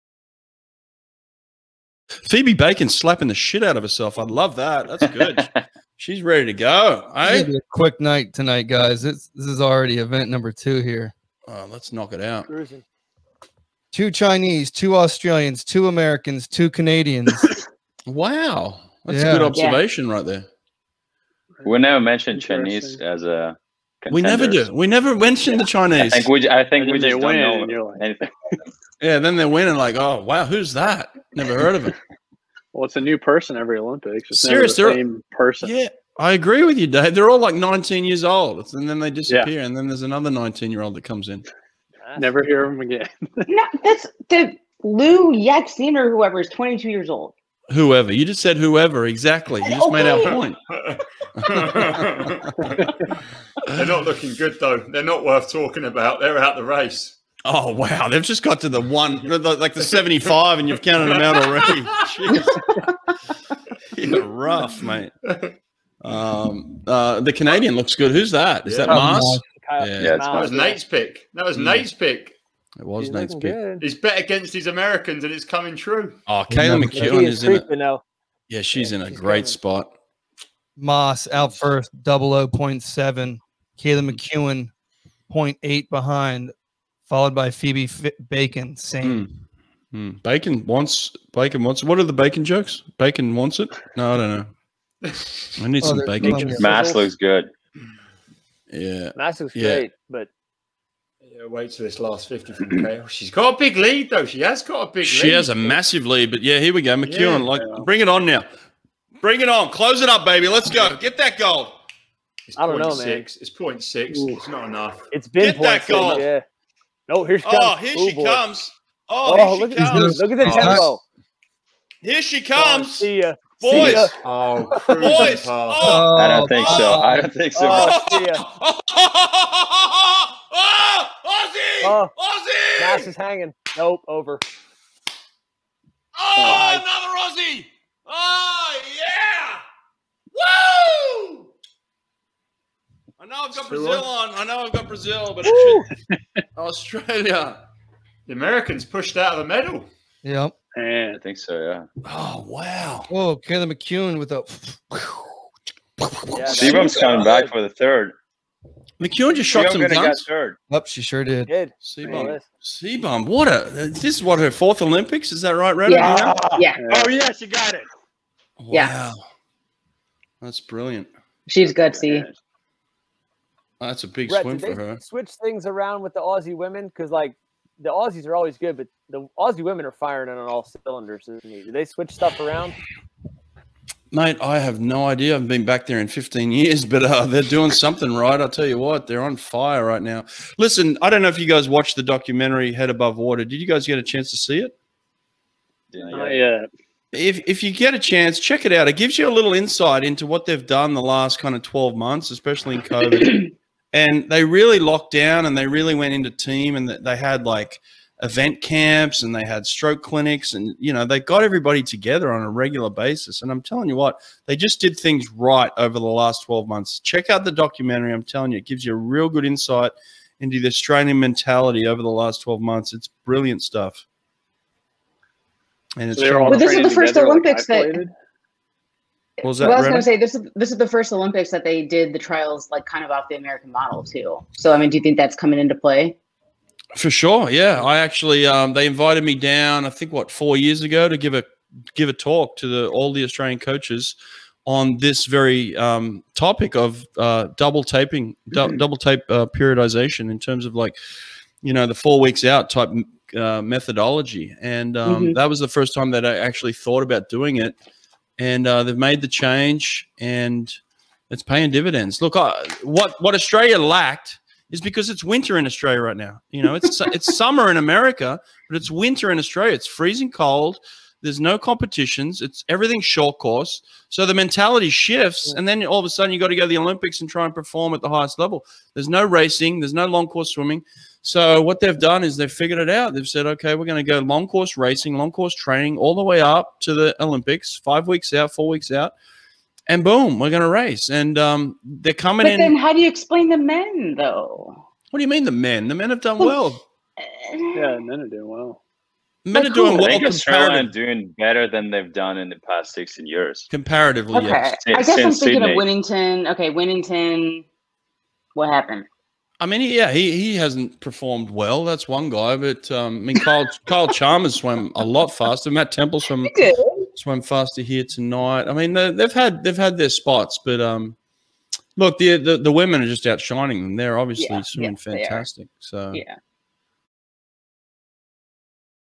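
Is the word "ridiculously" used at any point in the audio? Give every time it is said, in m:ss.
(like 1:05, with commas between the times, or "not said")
not said.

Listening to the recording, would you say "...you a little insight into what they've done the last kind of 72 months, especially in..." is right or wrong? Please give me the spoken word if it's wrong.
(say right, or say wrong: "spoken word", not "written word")
wrong: "12", not "72".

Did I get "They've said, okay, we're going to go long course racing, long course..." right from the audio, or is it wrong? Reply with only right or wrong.
right.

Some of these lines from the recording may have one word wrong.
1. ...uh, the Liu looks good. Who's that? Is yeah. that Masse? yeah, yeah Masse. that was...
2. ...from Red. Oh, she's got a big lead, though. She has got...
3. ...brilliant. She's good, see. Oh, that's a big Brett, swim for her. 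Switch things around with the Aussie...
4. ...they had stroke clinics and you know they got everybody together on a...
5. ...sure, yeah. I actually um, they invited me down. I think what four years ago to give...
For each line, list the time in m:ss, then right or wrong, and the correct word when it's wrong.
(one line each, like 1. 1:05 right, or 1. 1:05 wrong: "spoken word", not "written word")
1. 1:06 wrong: "Canadian", not "Liu"
2. 1:42 wrong: "Kale", not "Red"
3. 2:50 right
4. 3:29 right
5. 3:57 right.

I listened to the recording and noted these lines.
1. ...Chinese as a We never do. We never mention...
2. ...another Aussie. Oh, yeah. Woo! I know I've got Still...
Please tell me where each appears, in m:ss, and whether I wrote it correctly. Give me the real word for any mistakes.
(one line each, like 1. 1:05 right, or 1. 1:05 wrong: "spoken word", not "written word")
1. 0:22 right
2. 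2:16 right.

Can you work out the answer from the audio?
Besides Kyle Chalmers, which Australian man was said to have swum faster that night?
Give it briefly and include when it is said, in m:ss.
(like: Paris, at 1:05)
Matt Temple, at 5:15.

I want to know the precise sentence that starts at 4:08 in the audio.
double tape uh, periodization in terms of like you know the four weeks out type uh, methodology, and um, mm -hmm.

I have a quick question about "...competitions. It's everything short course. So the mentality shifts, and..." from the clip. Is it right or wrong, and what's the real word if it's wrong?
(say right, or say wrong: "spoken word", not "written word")
right.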